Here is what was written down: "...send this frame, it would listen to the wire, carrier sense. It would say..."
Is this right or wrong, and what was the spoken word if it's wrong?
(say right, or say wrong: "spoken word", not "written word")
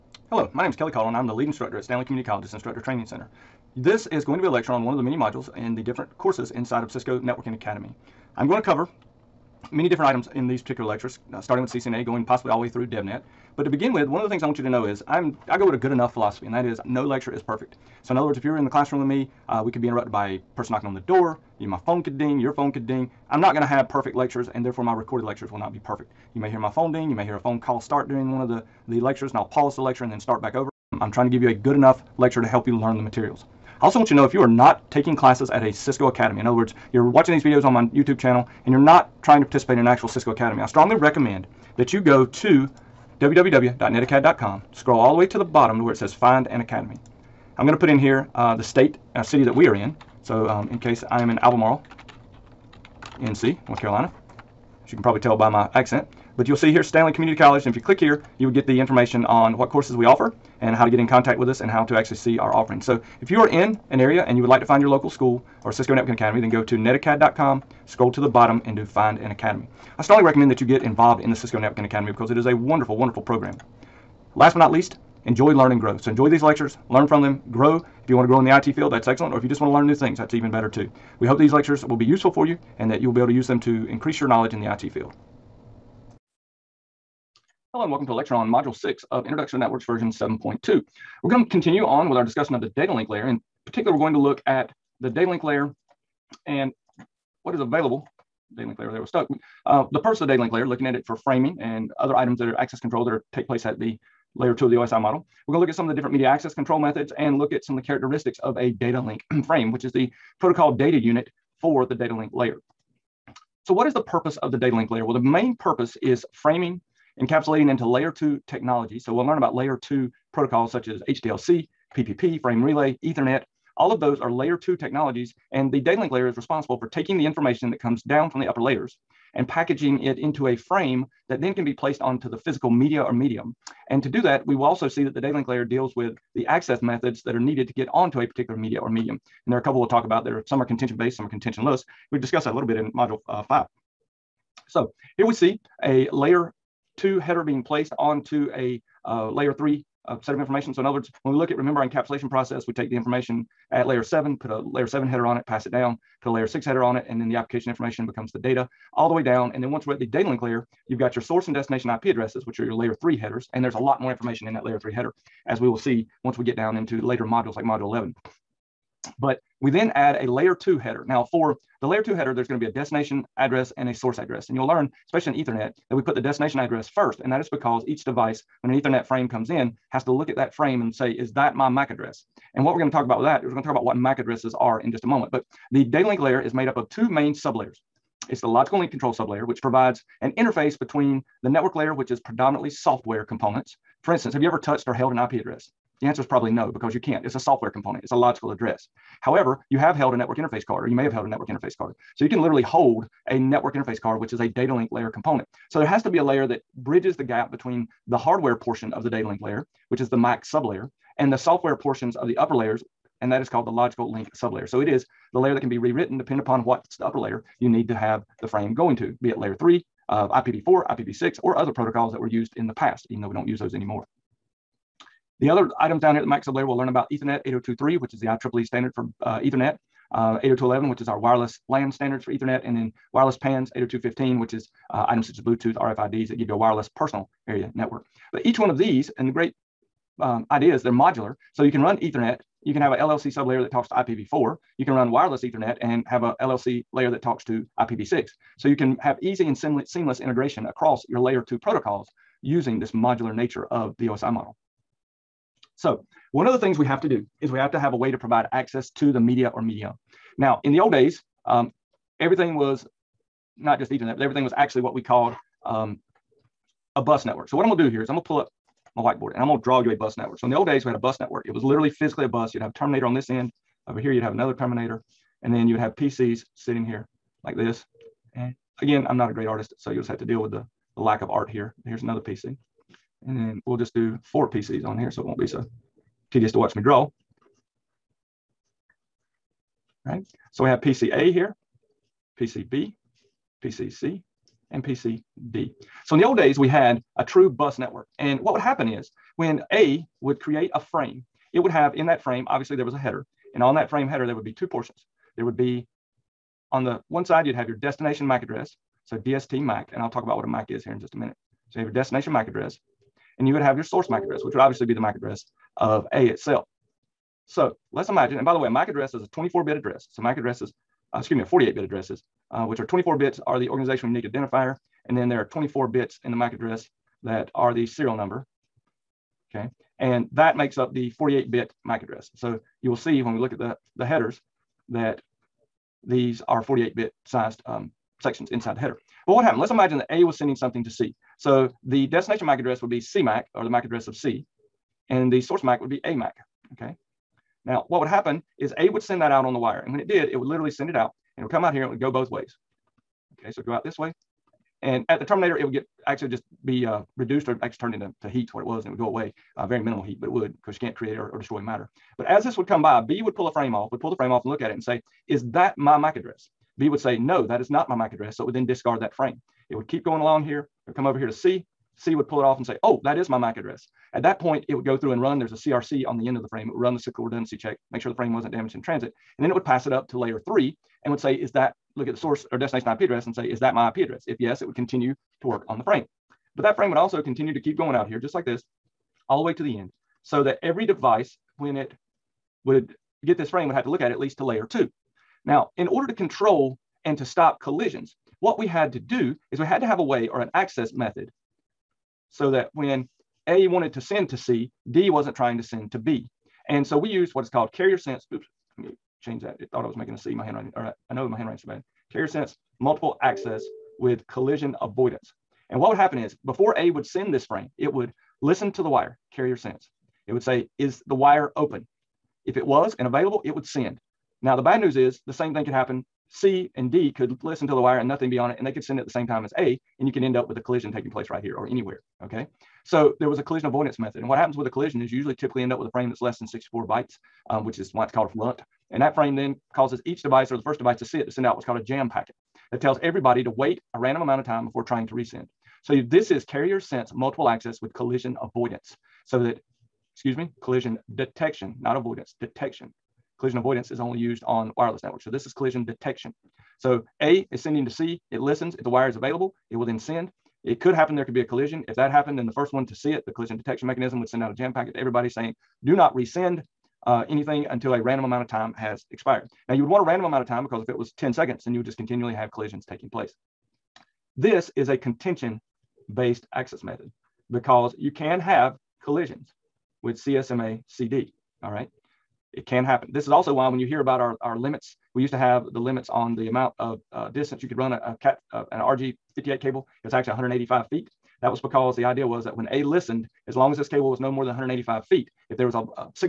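right.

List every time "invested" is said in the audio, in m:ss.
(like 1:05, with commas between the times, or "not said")
not said.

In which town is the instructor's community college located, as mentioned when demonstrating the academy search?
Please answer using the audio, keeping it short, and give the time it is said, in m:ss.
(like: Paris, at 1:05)
Albemarle, at 0:51.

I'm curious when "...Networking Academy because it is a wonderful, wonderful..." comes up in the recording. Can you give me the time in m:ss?
1:11.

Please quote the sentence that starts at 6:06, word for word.
B would say, no, that is not my MAC address.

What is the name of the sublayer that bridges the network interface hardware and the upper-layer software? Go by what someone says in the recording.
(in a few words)
logical link sublayer.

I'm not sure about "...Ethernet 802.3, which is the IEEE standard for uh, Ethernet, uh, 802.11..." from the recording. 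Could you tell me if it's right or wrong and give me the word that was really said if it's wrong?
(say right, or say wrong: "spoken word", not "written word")
right.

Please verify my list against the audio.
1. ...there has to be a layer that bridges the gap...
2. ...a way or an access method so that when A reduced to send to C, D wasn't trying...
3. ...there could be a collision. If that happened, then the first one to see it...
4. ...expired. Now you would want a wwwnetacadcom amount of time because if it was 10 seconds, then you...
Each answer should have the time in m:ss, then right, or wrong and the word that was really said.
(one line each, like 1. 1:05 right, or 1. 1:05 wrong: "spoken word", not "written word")
1. 3:25 right
2. 6:39 wrong: "wanted", not "reduced"
3. 7:41 right
4. 7:49 wrong: "random", not "wwwnetacadcom".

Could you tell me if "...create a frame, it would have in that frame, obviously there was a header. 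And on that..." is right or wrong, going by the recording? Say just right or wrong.
right.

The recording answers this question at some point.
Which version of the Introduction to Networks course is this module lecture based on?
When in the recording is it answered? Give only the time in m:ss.
1:29.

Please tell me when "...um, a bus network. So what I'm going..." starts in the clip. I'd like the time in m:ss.
4:25.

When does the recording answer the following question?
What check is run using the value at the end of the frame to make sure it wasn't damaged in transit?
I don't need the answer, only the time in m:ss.
6:16.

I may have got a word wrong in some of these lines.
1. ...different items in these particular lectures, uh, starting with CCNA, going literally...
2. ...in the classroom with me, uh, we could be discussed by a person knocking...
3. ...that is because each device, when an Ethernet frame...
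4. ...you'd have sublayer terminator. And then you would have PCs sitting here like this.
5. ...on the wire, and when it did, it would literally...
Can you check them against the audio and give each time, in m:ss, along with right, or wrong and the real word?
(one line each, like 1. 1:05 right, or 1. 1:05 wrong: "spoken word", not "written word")
1. 0:09 wrong: "possibly", not "literally"
2. 0:18 wrong: "interrupted", not "discussed"
3. 2:57 right
4. 4:34 wrong: "another", not "sublayer"
5. 5:49 right.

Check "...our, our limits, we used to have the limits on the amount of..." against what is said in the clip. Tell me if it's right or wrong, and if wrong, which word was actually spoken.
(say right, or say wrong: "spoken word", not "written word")
right.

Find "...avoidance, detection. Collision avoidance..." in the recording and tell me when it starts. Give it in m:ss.
7:31.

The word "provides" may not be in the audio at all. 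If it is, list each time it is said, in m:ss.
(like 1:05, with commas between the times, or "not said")
3:09, 4:18.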